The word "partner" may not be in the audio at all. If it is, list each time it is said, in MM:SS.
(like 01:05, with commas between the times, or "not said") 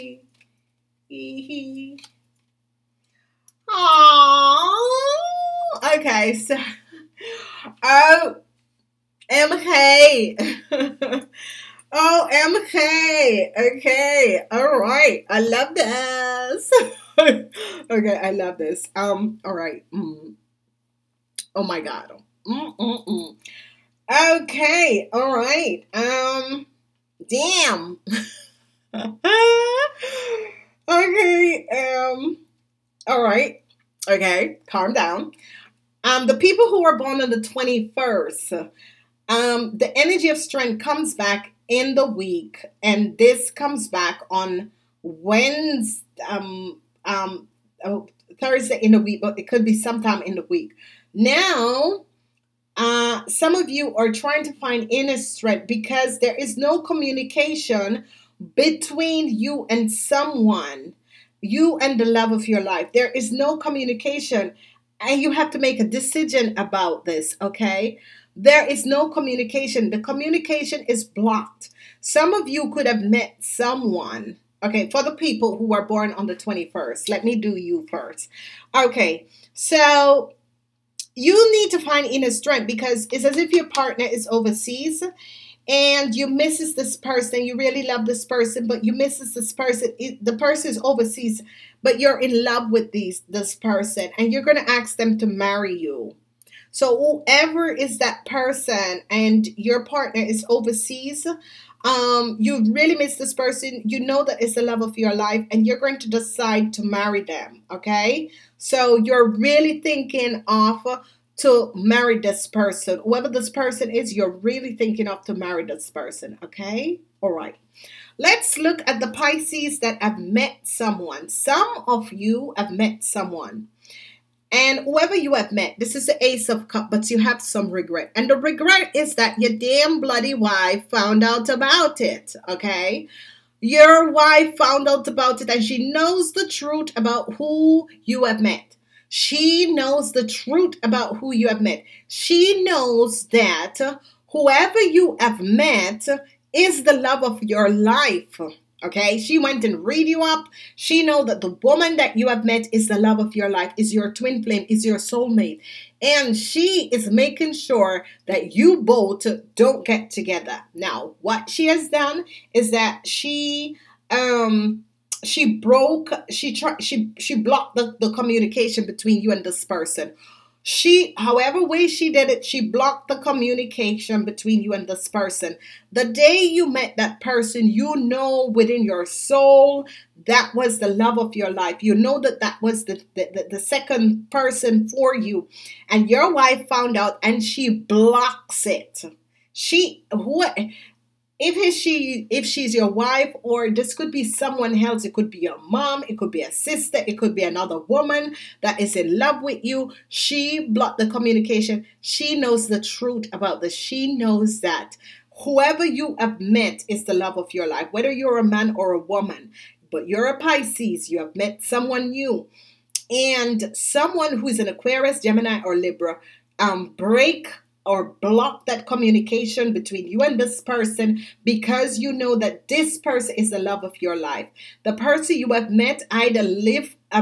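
01:23, 01:39.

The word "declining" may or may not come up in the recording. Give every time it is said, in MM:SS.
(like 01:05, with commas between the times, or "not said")
not said.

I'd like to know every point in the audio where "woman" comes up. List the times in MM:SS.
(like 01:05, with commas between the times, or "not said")
02:31, 03:17, 03:28.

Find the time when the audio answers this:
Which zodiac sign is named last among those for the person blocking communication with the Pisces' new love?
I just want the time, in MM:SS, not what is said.
03:35.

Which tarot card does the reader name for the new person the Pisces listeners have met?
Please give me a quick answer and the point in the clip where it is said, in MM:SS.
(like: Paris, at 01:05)
Ace of Cups, at 02:06.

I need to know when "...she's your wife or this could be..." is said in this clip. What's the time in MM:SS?
03:12.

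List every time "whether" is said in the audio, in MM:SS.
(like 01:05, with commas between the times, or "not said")
03:27.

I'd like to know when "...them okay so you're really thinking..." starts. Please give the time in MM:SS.
01:47.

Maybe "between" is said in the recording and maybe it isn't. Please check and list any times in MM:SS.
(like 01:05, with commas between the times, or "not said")
00:58, 02:48, 02:54, 03:39.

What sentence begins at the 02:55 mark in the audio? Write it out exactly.
The day you met that person, you know within your soul that was the love of your life.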